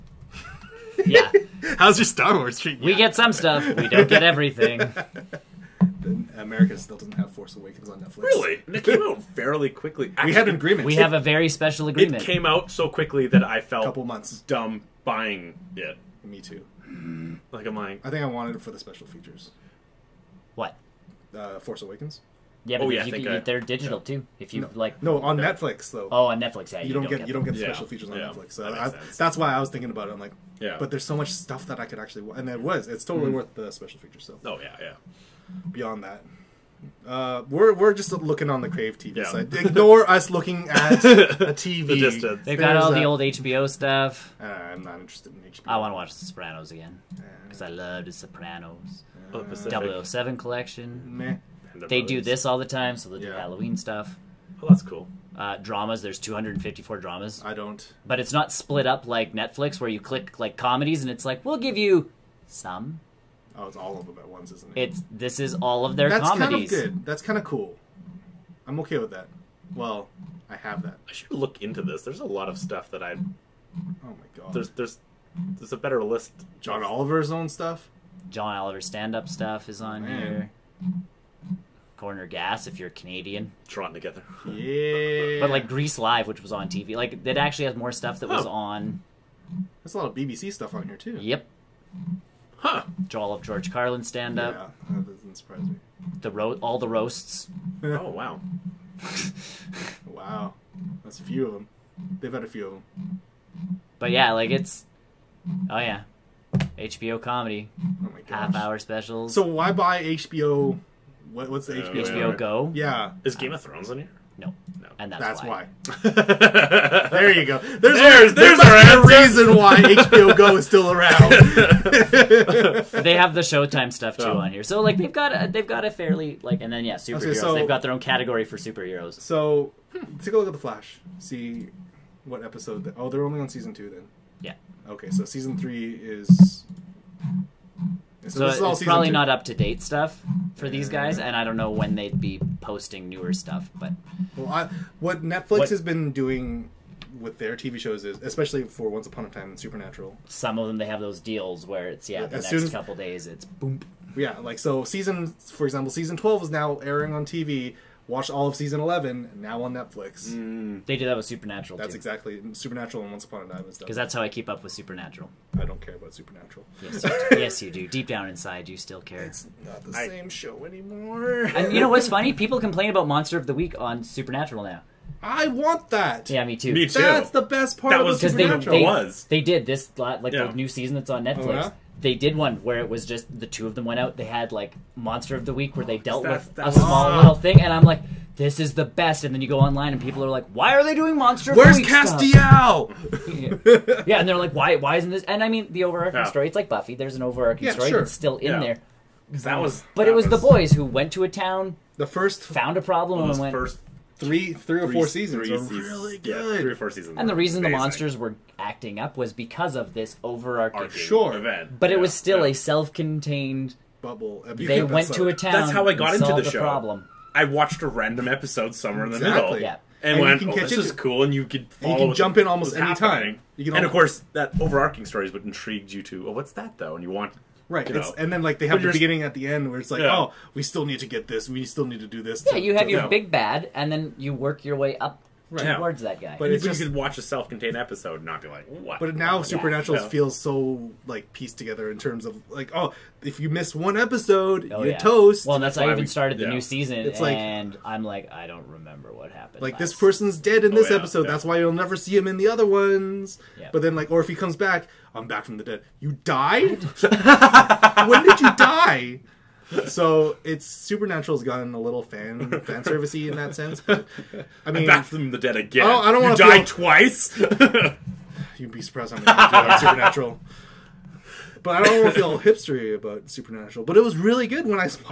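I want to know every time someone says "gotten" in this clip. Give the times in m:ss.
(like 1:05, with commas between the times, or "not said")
4:21.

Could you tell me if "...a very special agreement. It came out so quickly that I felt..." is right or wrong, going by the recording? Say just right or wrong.
right.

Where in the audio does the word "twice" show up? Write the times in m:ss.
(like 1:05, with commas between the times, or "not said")
4:26.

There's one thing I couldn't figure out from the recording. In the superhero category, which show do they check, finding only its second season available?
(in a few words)
The Flash.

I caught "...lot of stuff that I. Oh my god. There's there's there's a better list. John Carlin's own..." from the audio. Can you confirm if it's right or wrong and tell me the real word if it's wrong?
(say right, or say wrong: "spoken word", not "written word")
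wrong: "Oliver", not "Carlin".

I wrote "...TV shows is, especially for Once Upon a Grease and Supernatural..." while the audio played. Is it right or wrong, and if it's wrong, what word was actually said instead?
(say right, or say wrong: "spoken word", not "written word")
wrong: "Time", not "Grease".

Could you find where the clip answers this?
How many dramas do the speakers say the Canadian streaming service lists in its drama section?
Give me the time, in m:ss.
0:56.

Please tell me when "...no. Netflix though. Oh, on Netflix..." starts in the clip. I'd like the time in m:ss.
0:25.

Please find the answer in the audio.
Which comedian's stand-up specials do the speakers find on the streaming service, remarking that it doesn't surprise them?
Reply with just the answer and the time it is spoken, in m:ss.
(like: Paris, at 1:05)
George Carlin, at 1:33.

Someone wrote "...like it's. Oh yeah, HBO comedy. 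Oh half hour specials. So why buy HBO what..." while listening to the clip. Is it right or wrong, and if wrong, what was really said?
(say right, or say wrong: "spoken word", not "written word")
right.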